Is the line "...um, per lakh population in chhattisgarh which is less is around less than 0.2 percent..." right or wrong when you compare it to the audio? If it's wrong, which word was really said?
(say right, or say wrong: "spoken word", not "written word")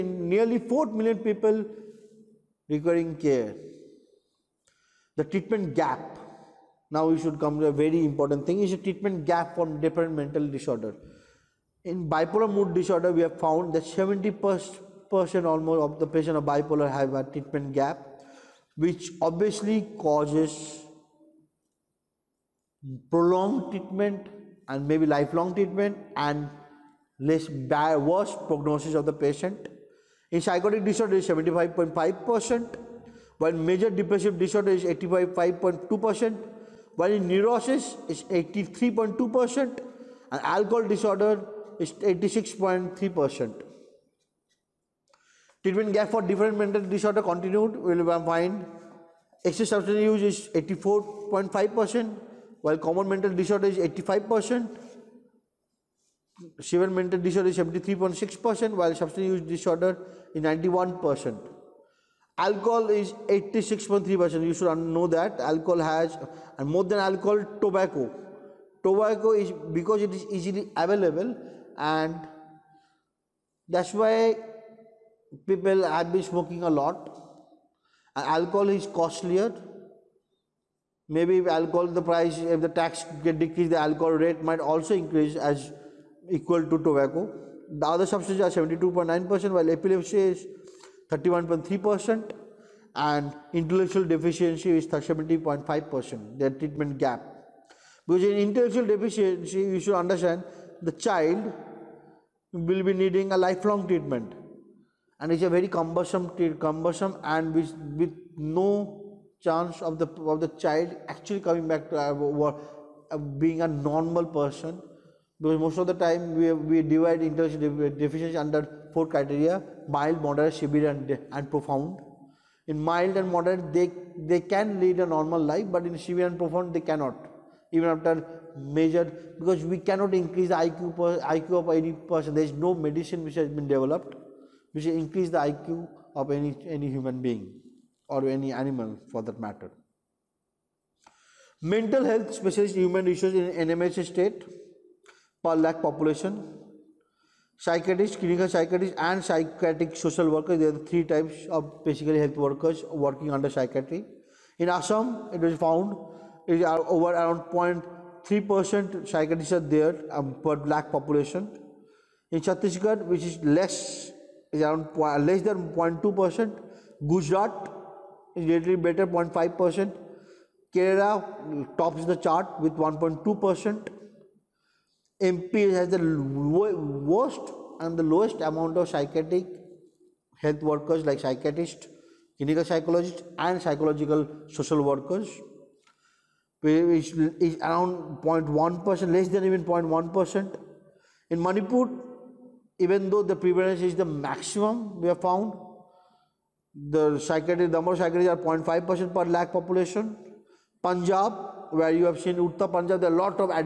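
right.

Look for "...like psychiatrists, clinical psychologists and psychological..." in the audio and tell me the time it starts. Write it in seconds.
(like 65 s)
181 s.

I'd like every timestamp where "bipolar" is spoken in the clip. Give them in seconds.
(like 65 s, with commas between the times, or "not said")
12 s, 16 s.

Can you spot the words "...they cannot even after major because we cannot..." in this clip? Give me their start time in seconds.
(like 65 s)
126 s.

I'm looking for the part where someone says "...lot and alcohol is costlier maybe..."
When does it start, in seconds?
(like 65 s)
76 s.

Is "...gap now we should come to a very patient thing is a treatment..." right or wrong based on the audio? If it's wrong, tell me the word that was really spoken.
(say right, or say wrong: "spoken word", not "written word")
wrong: "important", not "patient".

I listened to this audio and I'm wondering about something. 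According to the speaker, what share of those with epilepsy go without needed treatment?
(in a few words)
31.3%.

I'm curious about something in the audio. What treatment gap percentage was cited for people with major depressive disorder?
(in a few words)
85.2%.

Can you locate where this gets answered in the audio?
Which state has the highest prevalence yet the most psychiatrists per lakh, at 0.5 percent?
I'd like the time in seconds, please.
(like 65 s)
191 s.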